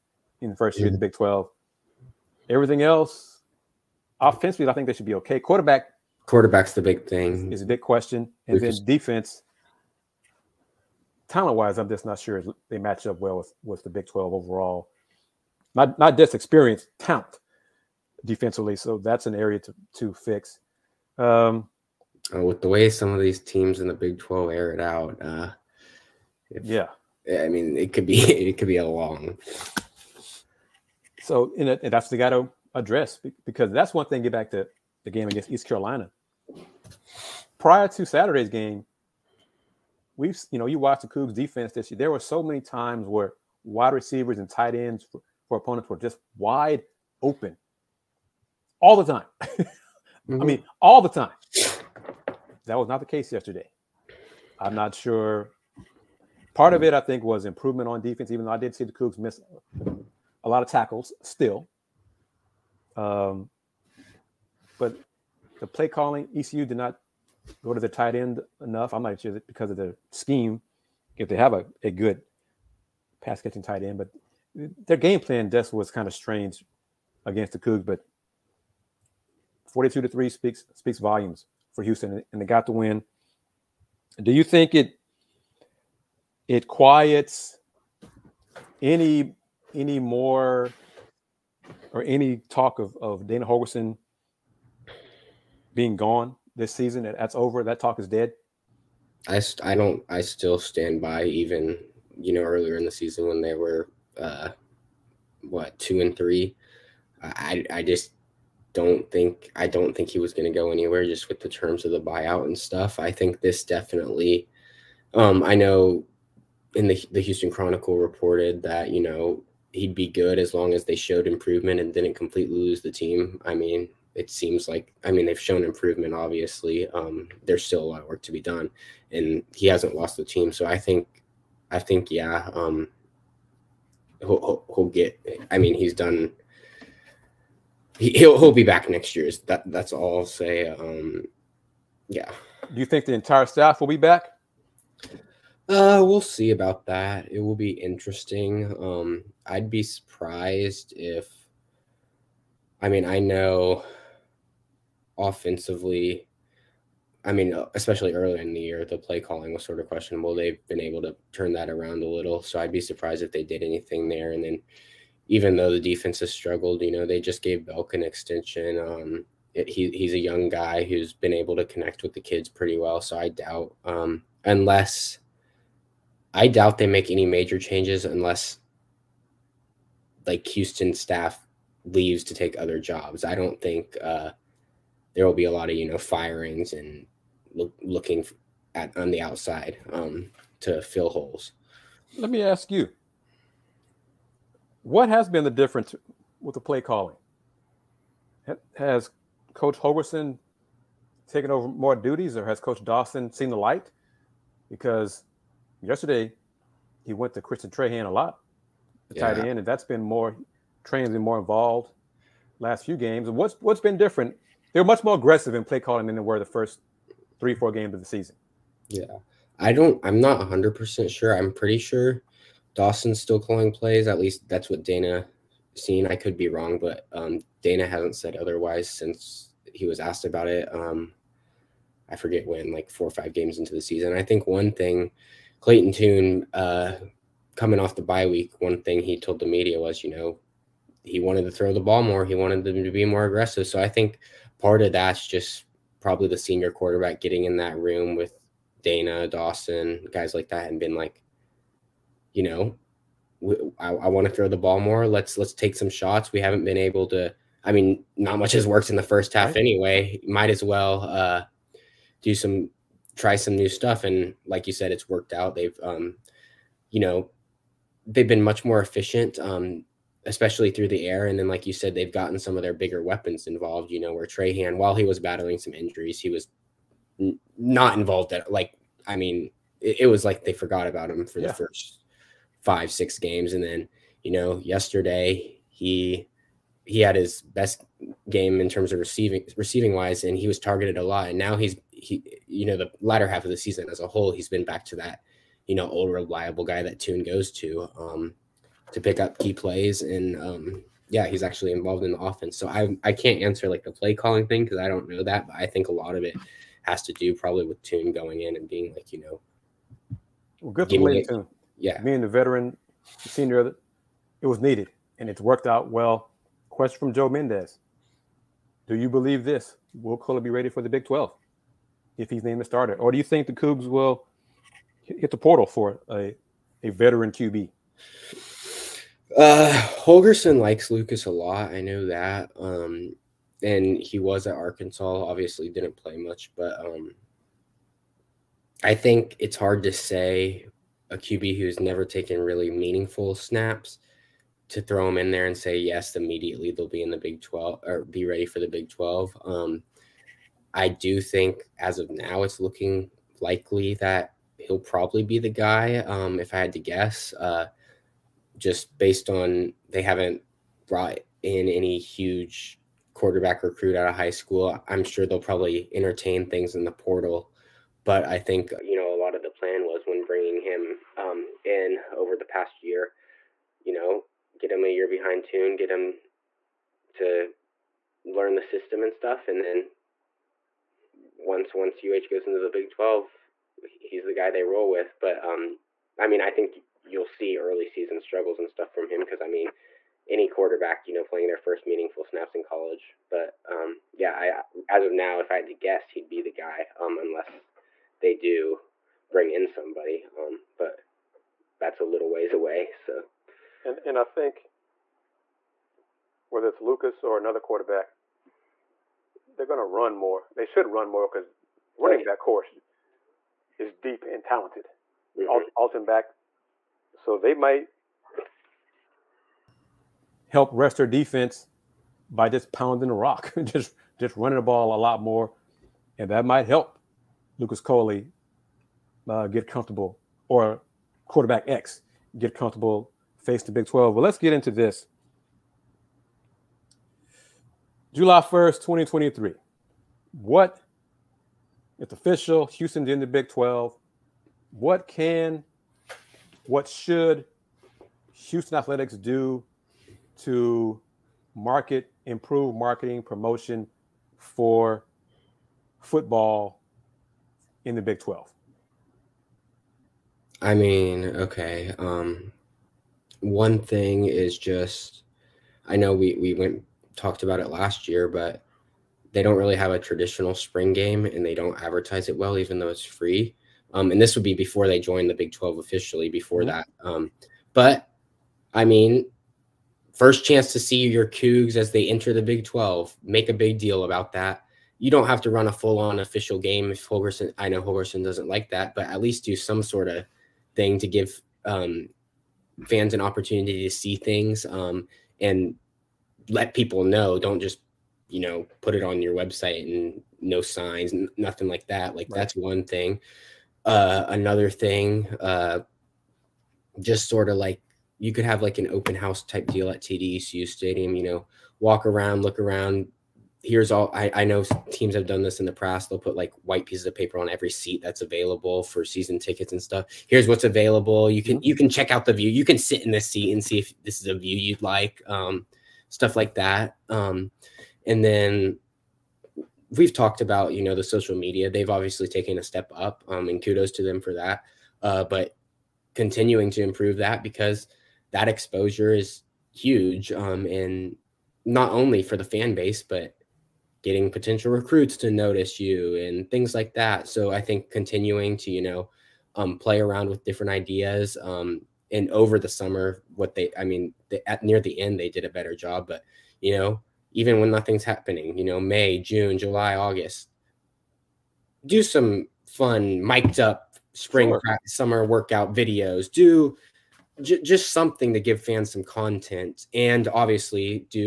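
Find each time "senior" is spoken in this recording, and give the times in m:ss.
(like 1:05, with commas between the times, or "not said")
4:06, 5:13.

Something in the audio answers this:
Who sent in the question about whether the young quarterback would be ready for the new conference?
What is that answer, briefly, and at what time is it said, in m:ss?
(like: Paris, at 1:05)
Joe Mendez, at 5:17.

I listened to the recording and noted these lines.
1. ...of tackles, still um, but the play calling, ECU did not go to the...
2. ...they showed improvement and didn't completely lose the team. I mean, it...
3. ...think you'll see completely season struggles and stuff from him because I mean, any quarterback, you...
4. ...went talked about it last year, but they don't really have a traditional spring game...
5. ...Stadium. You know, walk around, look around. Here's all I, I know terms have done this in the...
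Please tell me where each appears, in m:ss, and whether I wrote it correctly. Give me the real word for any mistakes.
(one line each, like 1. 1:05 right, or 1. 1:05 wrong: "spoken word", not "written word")
1. 1:00 right
2. 2:00 right
3. 6:26 wrong: "early", not "completely"
4. 7:46 right
5. 8:30 wrong: "teams", not "terms".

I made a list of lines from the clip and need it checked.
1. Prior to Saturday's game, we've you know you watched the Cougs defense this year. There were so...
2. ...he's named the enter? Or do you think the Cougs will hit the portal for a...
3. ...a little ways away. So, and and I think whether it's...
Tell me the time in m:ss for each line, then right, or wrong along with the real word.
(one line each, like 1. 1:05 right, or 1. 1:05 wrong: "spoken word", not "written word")
1. 0:37 right
2. 5:22 wrong: "starter", not "enter"
3. 6:42 right.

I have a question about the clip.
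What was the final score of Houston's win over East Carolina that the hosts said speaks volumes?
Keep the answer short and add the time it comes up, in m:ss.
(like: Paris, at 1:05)
42 to 3, at 1:19.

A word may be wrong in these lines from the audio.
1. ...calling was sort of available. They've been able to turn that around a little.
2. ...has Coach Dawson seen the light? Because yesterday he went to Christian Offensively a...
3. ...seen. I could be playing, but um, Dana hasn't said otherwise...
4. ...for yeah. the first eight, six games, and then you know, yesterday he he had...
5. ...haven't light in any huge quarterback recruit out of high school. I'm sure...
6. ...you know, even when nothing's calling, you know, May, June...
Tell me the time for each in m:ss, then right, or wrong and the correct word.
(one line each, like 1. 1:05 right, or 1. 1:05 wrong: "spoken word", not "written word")
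1. 2:39 wrong: "questionable", not "available"
2. 3:22 wrong: "Trahan", not "Offensively"
3. 3:45 wrong: "wrong", not "playing"
4. 4:41 wrong: "five", not "eight"
5. 6:00 wrong: "brought", not "light"
6. 9:16 wrong: "happening", not "calling".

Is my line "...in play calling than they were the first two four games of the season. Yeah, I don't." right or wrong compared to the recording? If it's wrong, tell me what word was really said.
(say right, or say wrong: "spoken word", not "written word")
wrong: "three", not "two".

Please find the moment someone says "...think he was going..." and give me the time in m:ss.
1:49.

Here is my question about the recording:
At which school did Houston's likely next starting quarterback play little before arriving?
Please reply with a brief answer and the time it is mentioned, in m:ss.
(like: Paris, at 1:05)
Arkansas, at 5:34.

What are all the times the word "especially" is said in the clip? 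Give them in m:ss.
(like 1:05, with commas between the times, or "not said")
2:37, 4:30.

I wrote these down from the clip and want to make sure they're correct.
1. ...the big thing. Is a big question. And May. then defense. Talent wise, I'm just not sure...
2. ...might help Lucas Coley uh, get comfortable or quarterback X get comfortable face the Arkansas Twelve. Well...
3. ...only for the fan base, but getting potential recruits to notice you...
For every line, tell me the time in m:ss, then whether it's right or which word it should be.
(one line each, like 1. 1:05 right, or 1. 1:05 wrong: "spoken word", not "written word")
1. 0:06 wrong: "Lucas", not "May"
2. 7:06 wrong: "Big", not "Arkansas"
3. 9:01 right.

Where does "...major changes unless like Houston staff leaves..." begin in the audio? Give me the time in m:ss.
2:57.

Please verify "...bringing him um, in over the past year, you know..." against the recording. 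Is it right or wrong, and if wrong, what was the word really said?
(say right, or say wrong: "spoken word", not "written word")
right.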